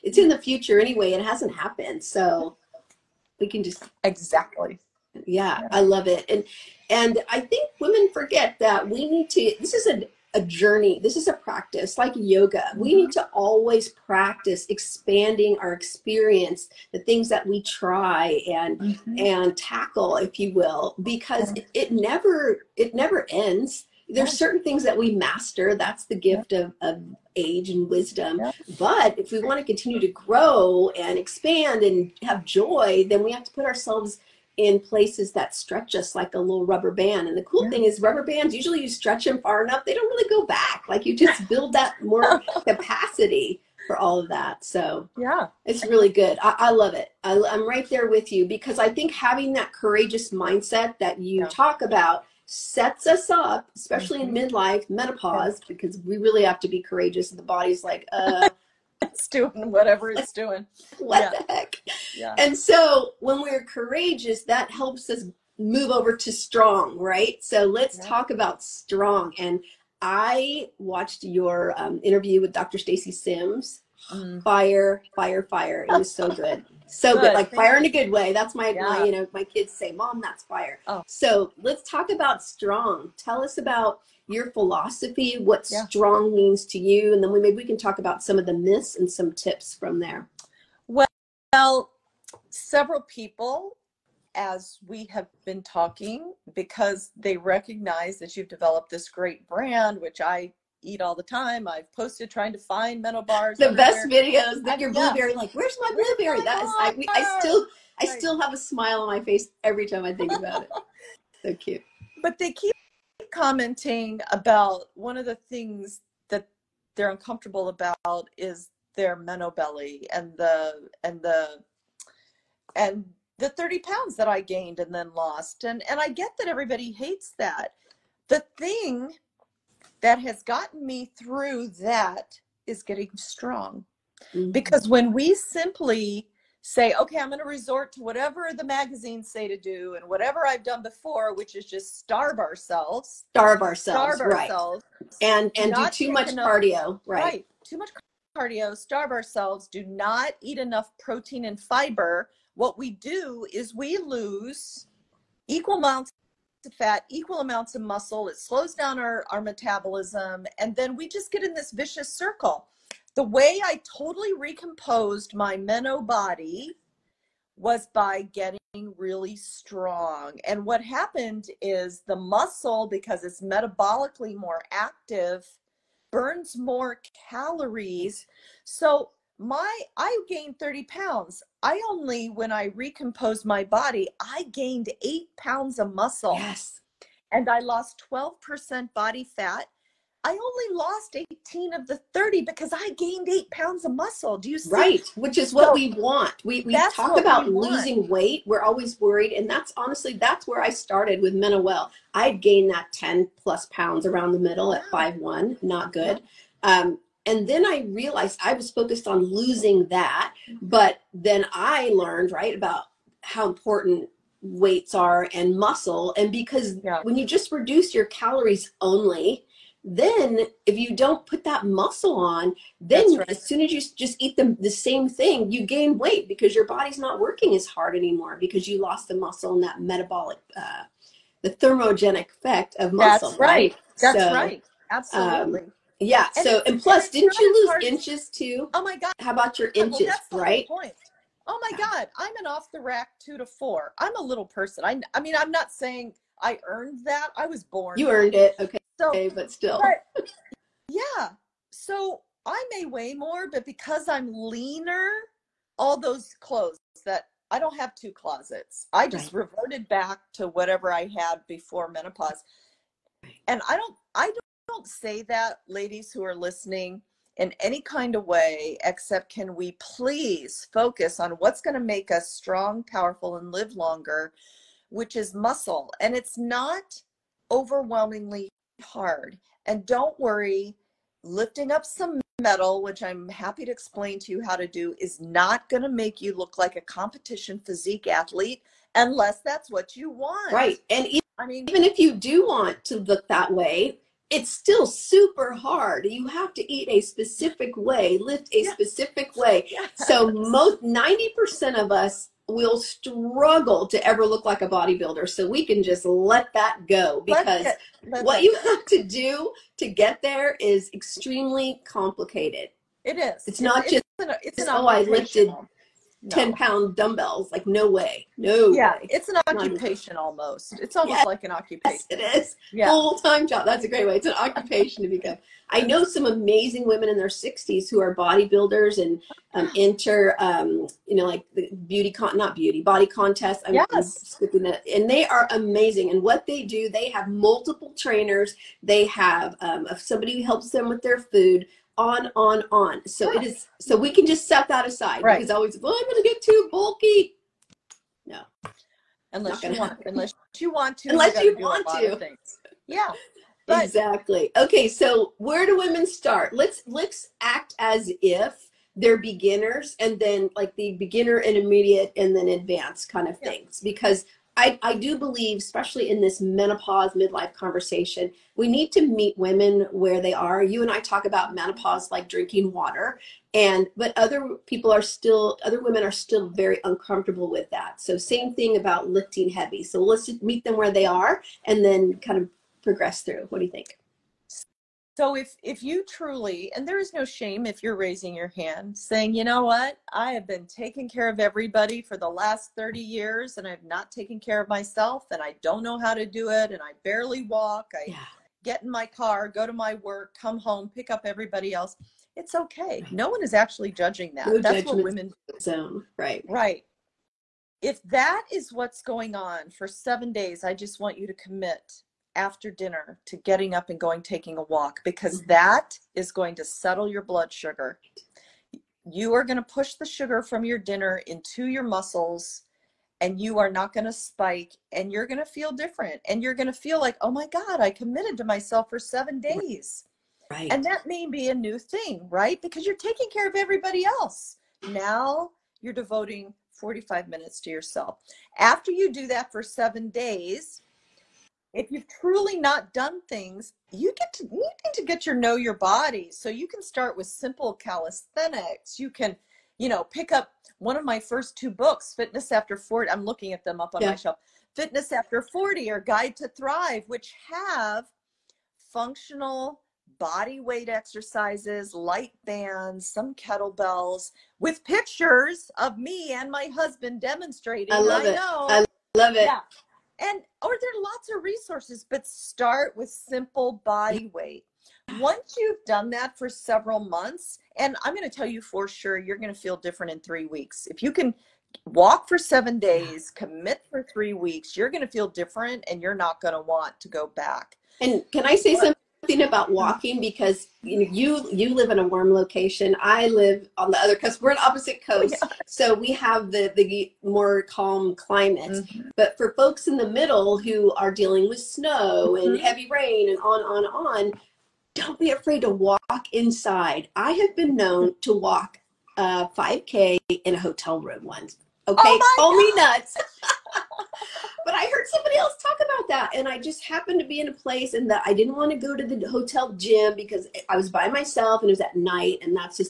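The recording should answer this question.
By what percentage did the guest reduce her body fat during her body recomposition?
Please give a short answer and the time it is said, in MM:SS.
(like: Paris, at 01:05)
12%, at 03:08.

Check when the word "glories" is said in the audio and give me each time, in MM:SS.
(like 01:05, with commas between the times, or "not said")
not said.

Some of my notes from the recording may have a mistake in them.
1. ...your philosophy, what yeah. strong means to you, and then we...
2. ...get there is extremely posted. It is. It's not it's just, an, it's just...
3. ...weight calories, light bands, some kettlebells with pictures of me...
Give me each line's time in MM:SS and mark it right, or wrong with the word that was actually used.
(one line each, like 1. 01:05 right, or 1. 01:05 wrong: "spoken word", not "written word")
1. 01:24 right
2. 05:09 wrong: "complicated", not "posted"
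3. 07:40 wrong: "exercises", not "calories".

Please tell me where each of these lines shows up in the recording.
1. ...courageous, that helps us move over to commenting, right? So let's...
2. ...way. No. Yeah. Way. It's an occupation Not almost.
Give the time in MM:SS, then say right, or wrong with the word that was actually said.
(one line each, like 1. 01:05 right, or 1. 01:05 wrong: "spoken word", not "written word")
1. 01:03 wrong: "strong", not "commenting"
2. 05:17 right.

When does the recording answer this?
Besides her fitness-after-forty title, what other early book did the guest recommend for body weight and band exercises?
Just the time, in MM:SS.
07:35.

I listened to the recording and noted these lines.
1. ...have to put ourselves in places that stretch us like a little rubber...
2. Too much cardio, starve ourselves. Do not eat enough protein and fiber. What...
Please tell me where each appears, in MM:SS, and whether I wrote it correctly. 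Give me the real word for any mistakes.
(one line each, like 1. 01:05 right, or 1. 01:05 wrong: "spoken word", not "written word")
1. 00:33 right
2. 02:27 right.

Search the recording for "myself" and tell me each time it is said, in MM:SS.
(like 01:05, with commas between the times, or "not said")
06:34, 07:08, 08:41.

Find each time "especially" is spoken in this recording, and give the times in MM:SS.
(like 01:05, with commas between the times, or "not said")
00:53, 06:05.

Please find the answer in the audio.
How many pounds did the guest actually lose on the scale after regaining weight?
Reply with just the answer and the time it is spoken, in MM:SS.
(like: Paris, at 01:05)
18, at 03:11.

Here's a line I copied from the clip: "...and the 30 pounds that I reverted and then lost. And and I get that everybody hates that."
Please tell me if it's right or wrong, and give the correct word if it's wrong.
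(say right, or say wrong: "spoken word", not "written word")
wrong: "gained", not "reverted".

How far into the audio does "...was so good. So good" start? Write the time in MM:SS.
01:15.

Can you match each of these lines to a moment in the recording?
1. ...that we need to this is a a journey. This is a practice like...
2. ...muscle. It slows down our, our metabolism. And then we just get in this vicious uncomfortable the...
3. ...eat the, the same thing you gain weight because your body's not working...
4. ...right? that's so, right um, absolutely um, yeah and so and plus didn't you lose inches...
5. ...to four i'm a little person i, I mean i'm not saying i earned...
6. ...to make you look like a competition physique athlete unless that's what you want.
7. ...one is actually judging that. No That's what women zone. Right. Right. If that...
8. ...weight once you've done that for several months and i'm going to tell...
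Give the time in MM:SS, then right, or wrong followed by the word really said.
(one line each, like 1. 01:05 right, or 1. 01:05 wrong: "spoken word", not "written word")
1. 00:08 right
2. 02:37 wrong: "circle", not "uncomfortable"
3. 03:44 right
4. 03:53 right
5. 04:03 right
6. 04:45 right
7. 06:43 right
8. 07:54 right.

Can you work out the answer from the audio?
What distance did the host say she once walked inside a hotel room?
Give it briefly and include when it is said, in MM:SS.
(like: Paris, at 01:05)
5K, at 08:29.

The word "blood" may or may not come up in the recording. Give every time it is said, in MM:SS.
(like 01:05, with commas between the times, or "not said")
06:57.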